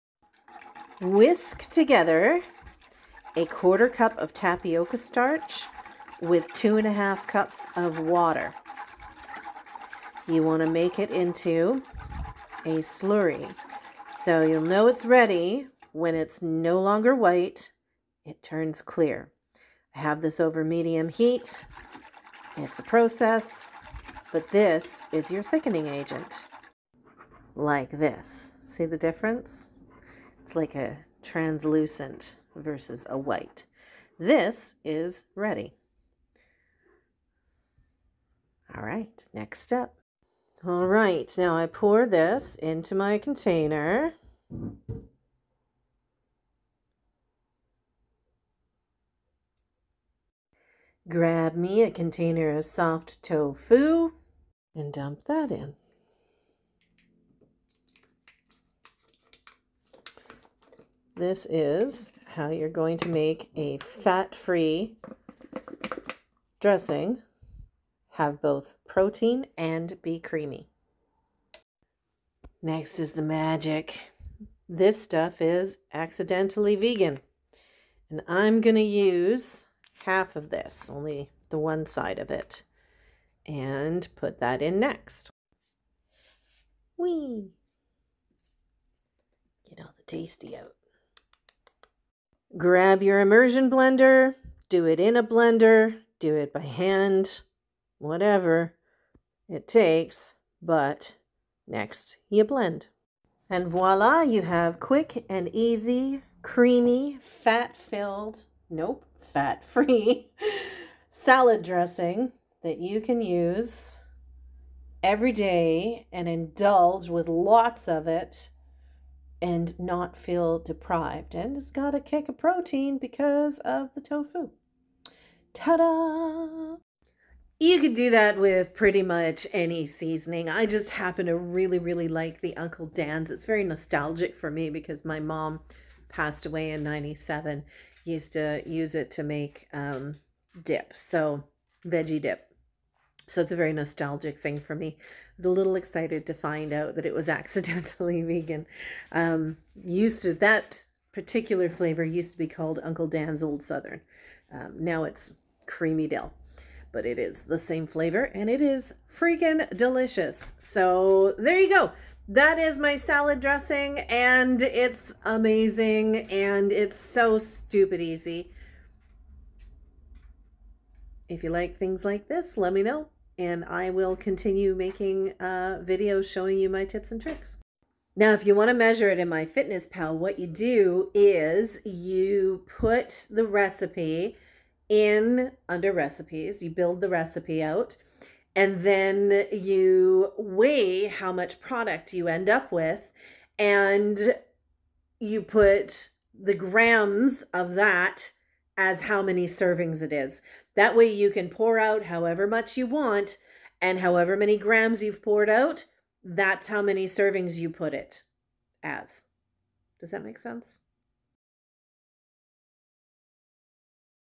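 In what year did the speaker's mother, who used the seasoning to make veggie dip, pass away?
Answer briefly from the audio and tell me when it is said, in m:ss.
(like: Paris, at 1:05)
1997, at 2:16.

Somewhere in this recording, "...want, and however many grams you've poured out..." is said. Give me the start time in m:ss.
3:22.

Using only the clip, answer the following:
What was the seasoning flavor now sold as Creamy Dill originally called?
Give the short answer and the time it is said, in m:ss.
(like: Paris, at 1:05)
Uncle Dan's Old Southern, at 2:32.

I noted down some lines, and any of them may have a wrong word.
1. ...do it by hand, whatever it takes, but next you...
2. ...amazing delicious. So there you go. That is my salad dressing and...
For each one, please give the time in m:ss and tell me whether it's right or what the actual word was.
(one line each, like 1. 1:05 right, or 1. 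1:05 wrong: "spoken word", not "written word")
1. 1:36 right
2. 2:39 wrong: "freaking", not "amazing".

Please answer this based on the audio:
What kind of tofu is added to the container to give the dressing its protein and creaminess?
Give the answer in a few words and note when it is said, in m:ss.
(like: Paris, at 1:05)
soft tofu, at 0:52.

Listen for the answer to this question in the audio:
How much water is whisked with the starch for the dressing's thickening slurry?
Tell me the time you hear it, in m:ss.
0:06.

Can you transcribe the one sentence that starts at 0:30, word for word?
It's like a translucent versus a white.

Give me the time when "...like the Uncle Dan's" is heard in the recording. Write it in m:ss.
2:12.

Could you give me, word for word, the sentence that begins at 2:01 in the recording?
And it's got a kick of protein because of the tofu.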